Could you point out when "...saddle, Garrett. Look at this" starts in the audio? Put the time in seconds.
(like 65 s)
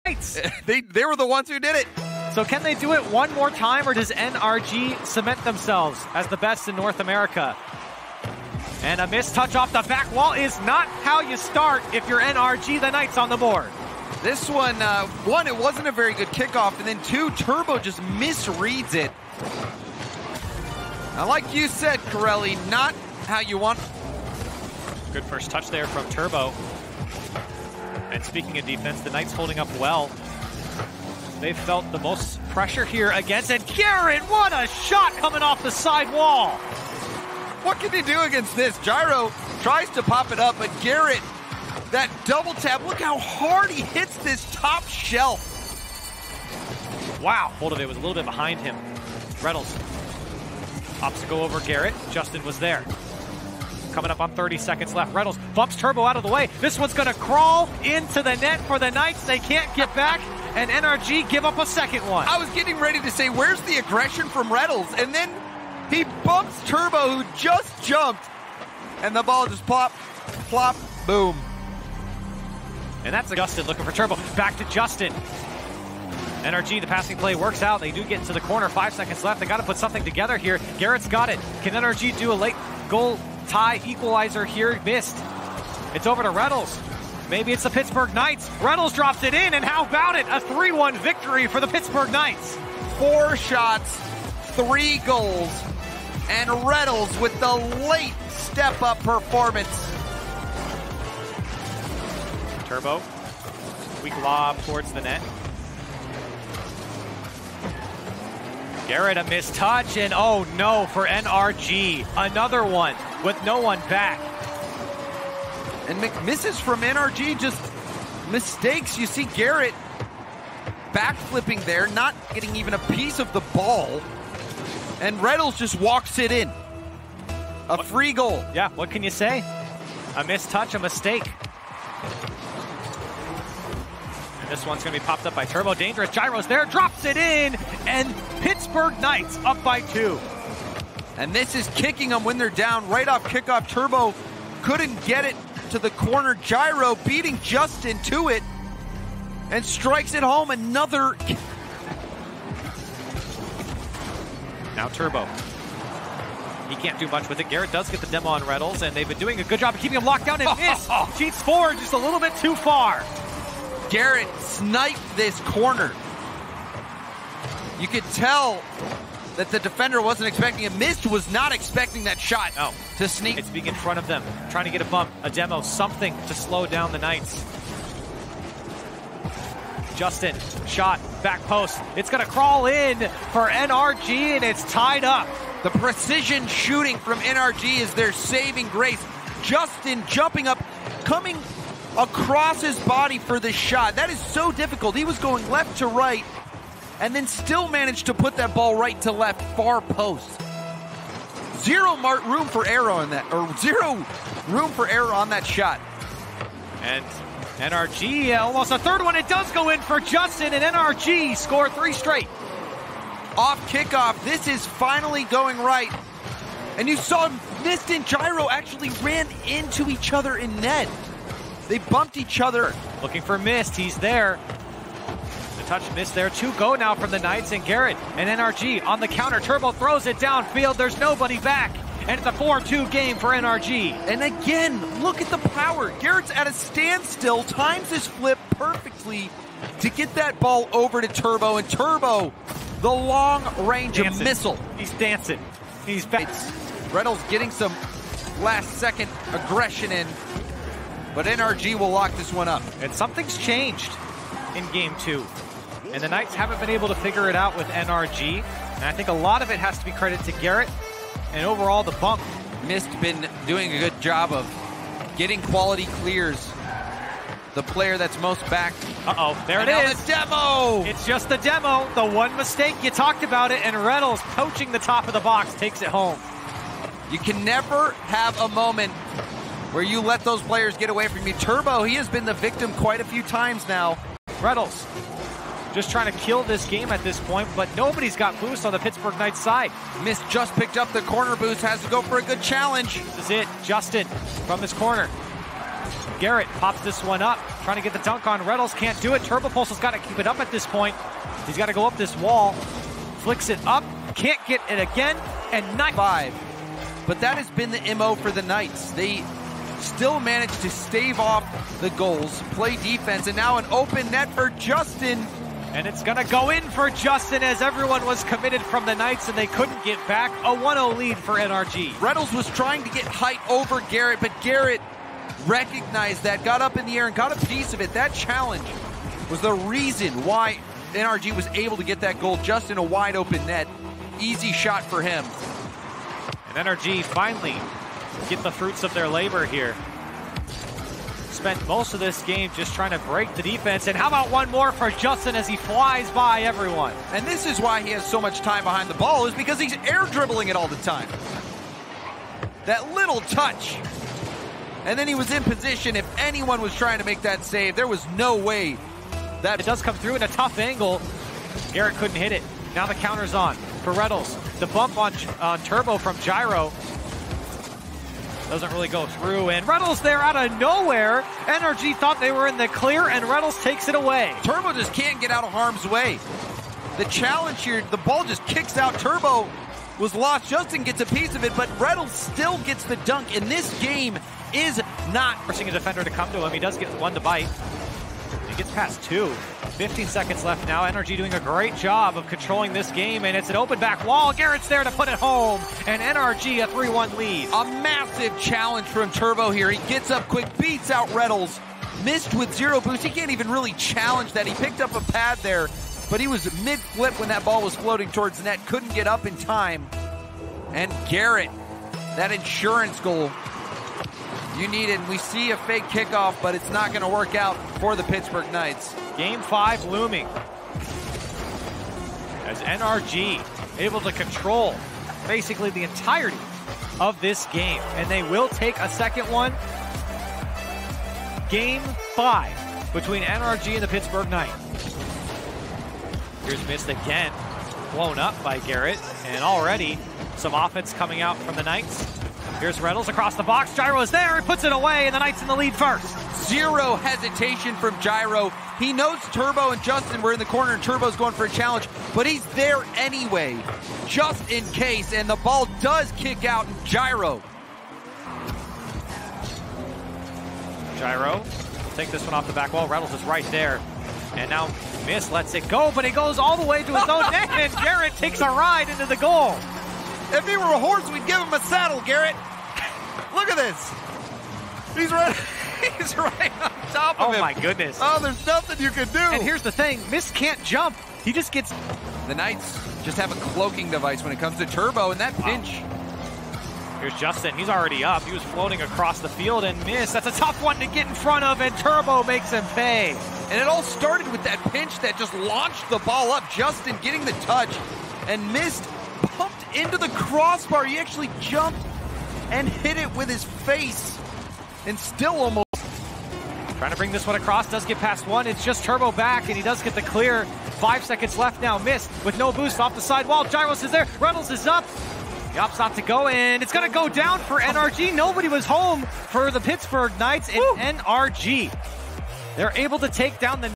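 471 s.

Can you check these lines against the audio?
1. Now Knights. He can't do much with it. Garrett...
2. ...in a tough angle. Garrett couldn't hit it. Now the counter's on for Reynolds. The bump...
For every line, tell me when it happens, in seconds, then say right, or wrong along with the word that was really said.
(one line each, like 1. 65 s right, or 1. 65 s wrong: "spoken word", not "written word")
1. 154 s wrong: "Turbo", not "Knights"
2. 360 s right.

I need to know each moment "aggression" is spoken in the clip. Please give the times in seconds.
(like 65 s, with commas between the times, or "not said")
63 s, 249 s.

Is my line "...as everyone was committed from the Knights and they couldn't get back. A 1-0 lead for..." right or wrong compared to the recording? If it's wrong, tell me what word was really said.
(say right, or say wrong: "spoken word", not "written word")
right.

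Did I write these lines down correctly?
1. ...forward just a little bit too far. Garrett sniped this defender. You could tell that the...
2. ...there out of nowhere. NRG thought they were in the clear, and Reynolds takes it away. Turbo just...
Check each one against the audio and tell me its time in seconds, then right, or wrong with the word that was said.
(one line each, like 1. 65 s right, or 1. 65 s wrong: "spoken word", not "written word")
1. 161 s wrong: "corner", not "defender"
2. 370 s right.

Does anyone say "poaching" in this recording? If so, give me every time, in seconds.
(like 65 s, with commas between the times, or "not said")
274 s.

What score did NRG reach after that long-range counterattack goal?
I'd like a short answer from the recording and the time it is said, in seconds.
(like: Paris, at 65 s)
4-2, at 232 s.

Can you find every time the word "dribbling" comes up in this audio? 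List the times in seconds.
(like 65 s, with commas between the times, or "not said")
350 s.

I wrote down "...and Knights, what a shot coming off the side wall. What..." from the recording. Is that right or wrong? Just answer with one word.
wrong.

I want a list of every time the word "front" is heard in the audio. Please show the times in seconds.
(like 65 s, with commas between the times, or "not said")
173 s, 491 s.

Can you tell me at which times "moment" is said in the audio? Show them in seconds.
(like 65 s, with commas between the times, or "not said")
278 s.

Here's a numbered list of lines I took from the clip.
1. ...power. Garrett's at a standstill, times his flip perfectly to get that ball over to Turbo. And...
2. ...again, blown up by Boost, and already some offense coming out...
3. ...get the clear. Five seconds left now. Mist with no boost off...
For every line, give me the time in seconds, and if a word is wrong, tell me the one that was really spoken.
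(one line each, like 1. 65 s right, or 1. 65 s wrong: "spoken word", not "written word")
1. 235 s right
2. 436 s wrong: "Garrett", not "Boost"
3. 509 s right.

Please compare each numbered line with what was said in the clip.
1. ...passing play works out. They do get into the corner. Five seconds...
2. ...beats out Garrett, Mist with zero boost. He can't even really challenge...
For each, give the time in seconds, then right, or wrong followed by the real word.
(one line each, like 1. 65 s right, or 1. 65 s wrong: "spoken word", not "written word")
1. 76 s right
2. 400 s wrong: "Reynolds", not "Garrett".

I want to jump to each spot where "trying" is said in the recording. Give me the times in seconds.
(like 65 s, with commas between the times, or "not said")
174 s, 285 s, 297 s, 322 s, 342 s, 356 s, 506 s.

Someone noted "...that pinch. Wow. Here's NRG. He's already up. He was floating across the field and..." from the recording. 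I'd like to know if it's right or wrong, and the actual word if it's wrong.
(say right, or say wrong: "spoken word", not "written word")
wrong: "Justin", not "NRG".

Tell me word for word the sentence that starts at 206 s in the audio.
And NRG almost a third one.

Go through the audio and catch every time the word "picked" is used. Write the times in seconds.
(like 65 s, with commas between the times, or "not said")
290 s, 404 s.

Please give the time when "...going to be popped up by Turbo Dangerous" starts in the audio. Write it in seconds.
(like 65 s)
134 s.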